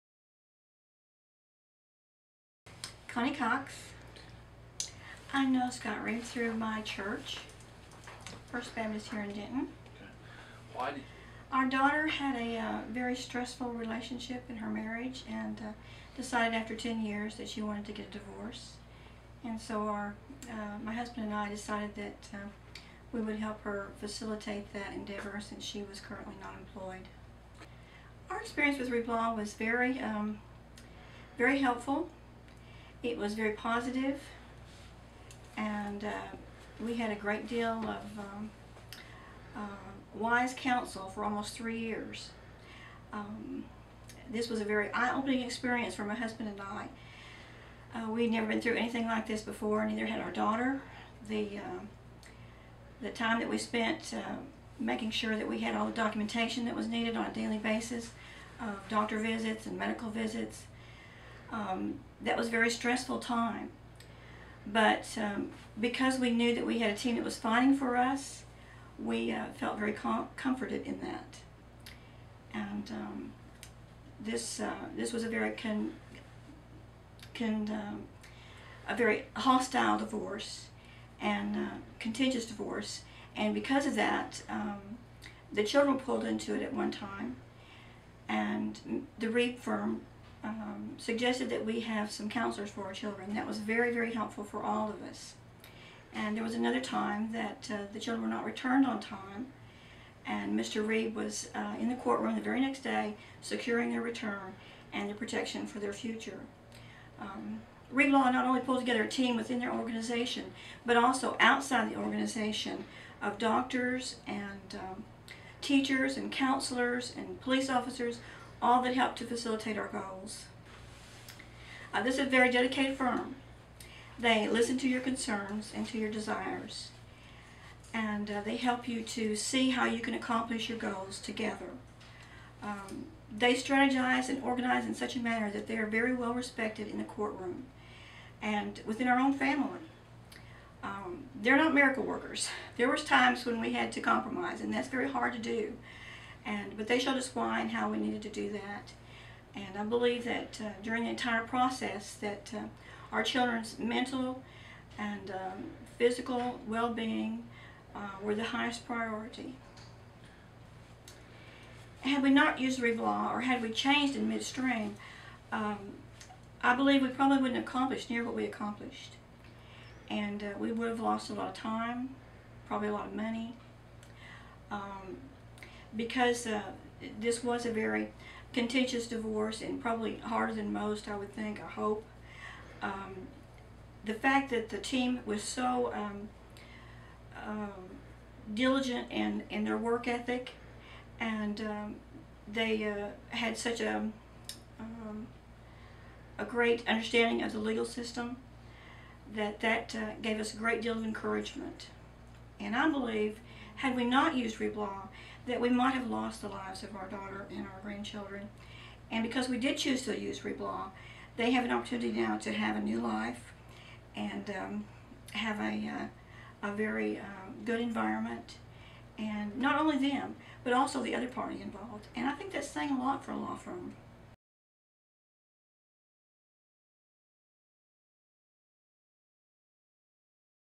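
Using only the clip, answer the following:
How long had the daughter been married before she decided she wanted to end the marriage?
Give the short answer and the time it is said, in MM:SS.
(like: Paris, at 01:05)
10 years, at 00:16.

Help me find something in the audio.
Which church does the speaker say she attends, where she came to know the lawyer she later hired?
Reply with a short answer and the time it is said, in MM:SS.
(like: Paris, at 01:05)
First Baptist, at 00:08.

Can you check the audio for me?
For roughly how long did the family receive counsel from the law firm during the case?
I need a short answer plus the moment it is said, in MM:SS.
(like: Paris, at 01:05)
almost 3 years, at 00:41.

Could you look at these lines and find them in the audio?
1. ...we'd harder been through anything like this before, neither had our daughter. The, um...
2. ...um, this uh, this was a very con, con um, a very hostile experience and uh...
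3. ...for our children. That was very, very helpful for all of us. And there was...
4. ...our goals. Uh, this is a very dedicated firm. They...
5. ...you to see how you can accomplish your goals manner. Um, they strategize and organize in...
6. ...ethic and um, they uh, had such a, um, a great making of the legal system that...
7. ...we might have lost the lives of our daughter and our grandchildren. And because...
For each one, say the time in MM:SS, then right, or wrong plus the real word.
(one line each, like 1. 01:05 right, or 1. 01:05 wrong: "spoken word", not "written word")
1. 00:48 wrong: "never", not "harder"
2. 01:12 wrong: "divorce", not "experience"
3. 01:32 right
4. 01:59 right
5. 02:08 wrong: "together", not "manner"
6. 03:10 wrong: "understanding", not "making"
7. 03:25 right.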